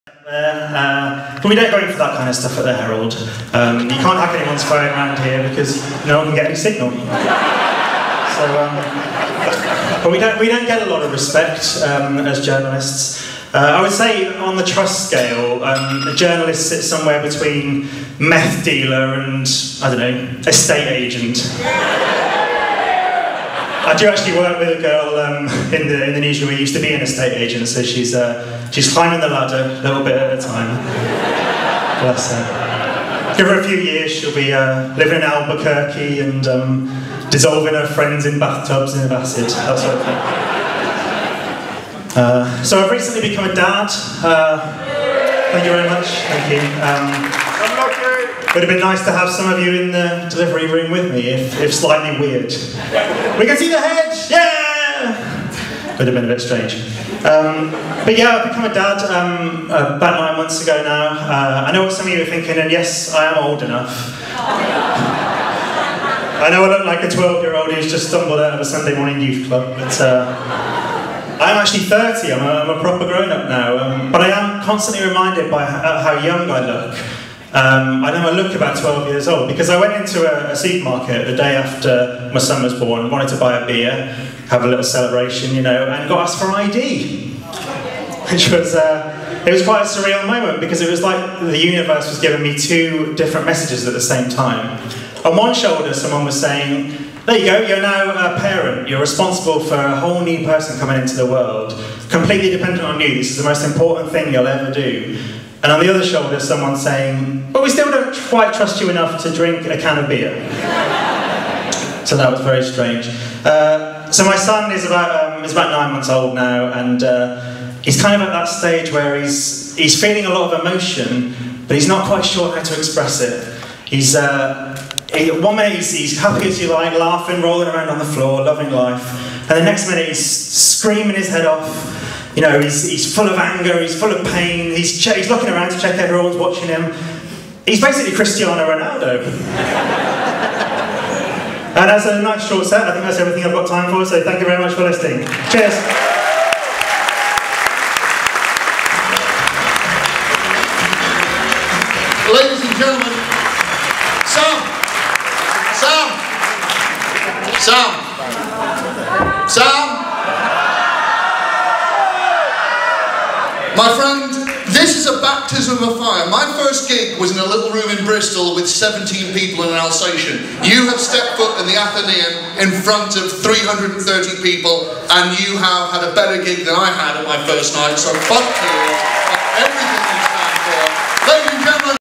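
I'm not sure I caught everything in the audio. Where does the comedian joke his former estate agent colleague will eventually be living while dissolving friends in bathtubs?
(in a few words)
Albuquerque.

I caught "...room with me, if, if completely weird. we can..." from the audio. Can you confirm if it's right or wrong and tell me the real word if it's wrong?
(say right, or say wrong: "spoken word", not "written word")
wrong: "slightly", not "completely".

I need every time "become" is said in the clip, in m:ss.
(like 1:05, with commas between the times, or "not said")
0:43, 0:58.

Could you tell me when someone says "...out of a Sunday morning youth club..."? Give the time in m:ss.
1:08.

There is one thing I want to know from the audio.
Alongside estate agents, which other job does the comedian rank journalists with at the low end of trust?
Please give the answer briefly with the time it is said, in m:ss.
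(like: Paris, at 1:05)
meth dealer, at 0:18.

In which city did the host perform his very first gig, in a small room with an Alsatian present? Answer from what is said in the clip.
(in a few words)
Bristol.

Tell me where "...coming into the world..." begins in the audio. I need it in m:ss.
1:40.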